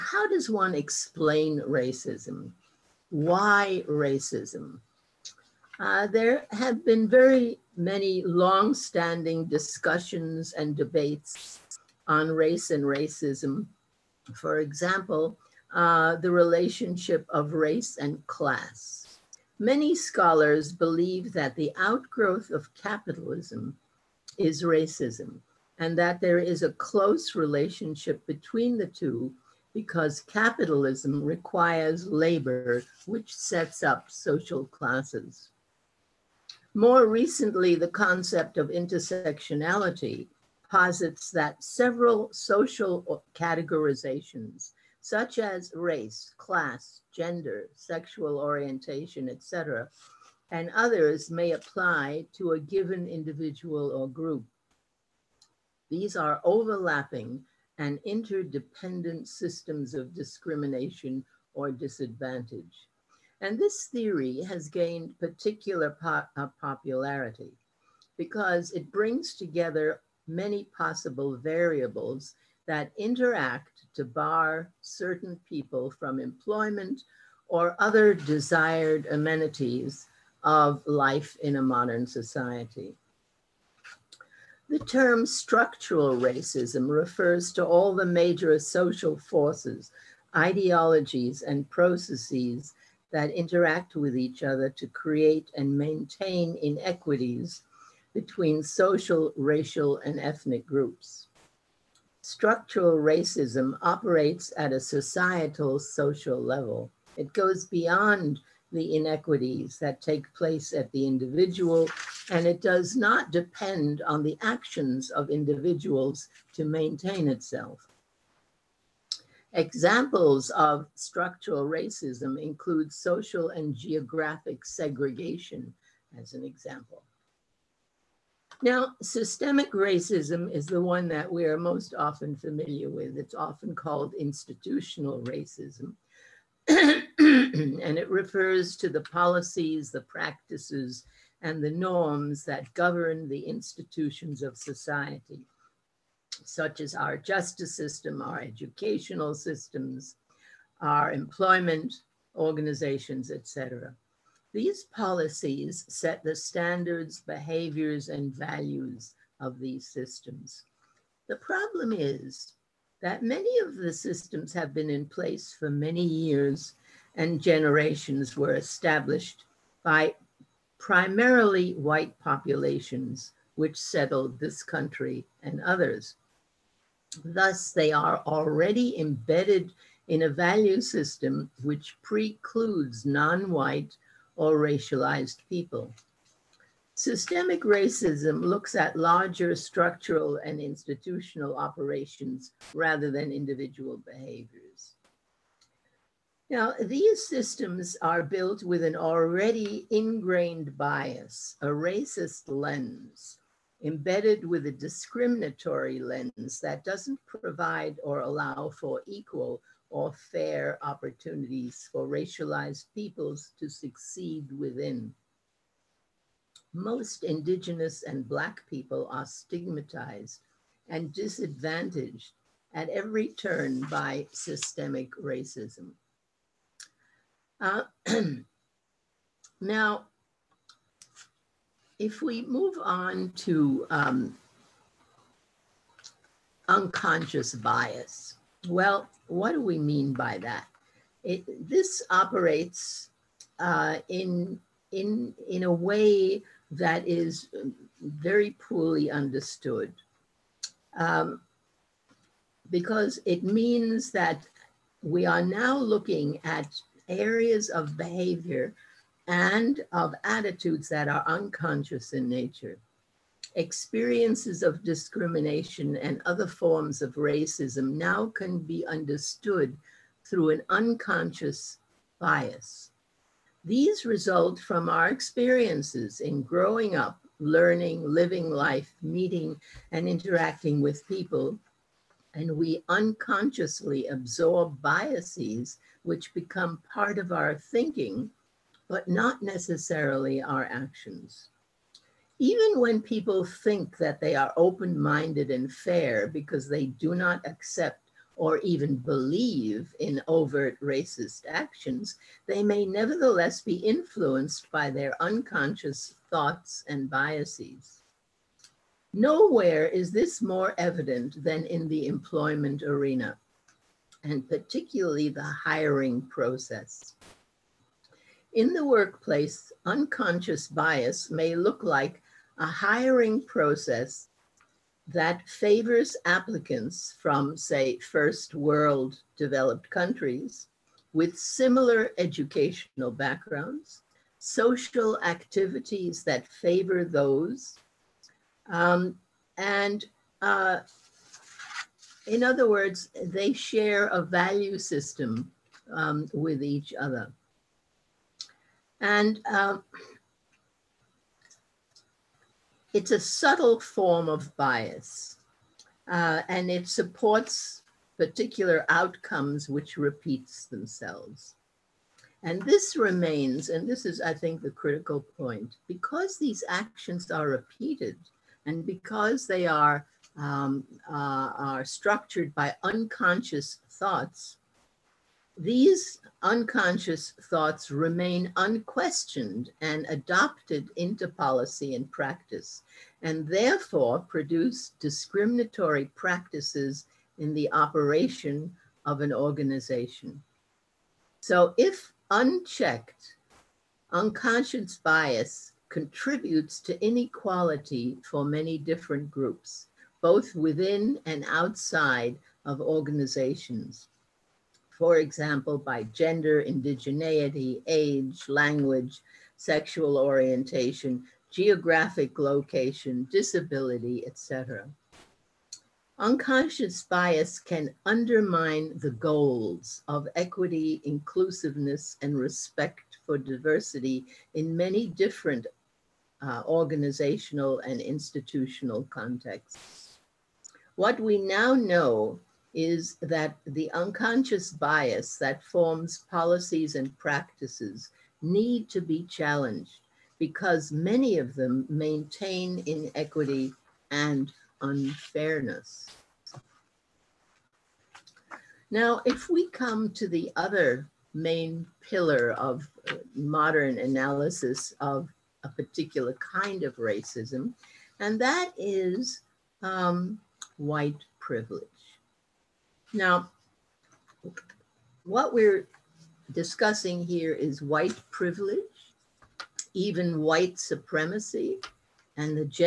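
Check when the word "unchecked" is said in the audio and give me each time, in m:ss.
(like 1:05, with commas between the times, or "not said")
6:32.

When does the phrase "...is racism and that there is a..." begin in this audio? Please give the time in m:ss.
0:24.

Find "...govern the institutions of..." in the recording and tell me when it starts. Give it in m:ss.
2:22.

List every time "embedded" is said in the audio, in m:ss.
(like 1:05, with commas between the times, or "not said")
2:58, 3:23.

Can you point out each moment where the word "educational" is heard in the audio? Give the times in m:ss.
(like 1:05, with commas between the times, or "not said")
2:28, 5:32.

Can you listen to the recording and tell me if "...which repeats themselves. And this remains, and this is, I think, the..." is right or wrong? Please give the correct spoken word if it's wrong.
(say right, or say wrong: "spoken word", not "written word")
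right.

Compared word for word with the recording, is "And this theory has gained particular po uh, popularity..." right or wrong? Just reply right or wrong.
right.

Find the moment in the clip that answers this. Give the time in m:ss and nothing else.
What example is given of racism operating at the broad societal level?
2:02.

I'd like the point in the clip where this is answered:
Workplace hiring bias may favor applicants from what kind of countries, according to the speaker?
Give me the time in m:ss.
5:27.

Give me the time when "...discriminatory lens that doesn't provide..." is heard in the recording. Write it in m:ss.
3:24.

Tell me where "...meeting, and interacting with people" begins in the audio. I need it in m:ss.
4:39.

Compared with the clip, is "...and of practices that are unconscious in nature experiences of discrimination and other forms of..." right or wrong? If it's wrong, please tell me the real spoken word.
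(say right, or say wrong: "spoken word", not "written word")
wrong: "attitudes", not "practices".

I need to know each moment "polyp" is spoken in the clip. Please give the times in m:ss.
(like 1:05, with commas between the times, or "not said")
not said.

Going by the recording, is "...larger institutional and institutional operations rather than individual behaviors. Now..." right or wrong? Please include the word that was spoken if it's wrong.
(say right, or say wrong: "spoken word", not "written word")
wrong: "structural", not "institutional".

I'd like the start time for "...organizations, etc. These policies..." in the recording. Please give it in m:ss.
2:32.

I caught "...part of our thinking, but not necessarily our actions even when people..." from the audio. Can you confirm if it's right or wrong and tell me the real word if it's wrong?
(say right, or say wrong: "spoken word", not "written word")
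right.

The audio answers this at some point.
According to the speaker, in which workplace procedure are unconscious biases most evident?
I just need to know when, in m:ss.
5:15.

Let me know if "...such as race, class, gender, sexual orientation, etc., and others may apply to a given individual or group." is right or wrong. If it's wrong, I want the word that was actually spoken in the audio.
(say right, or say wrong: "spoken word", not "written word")
right.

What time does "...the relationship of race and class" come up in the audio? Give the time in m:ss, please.
0:16.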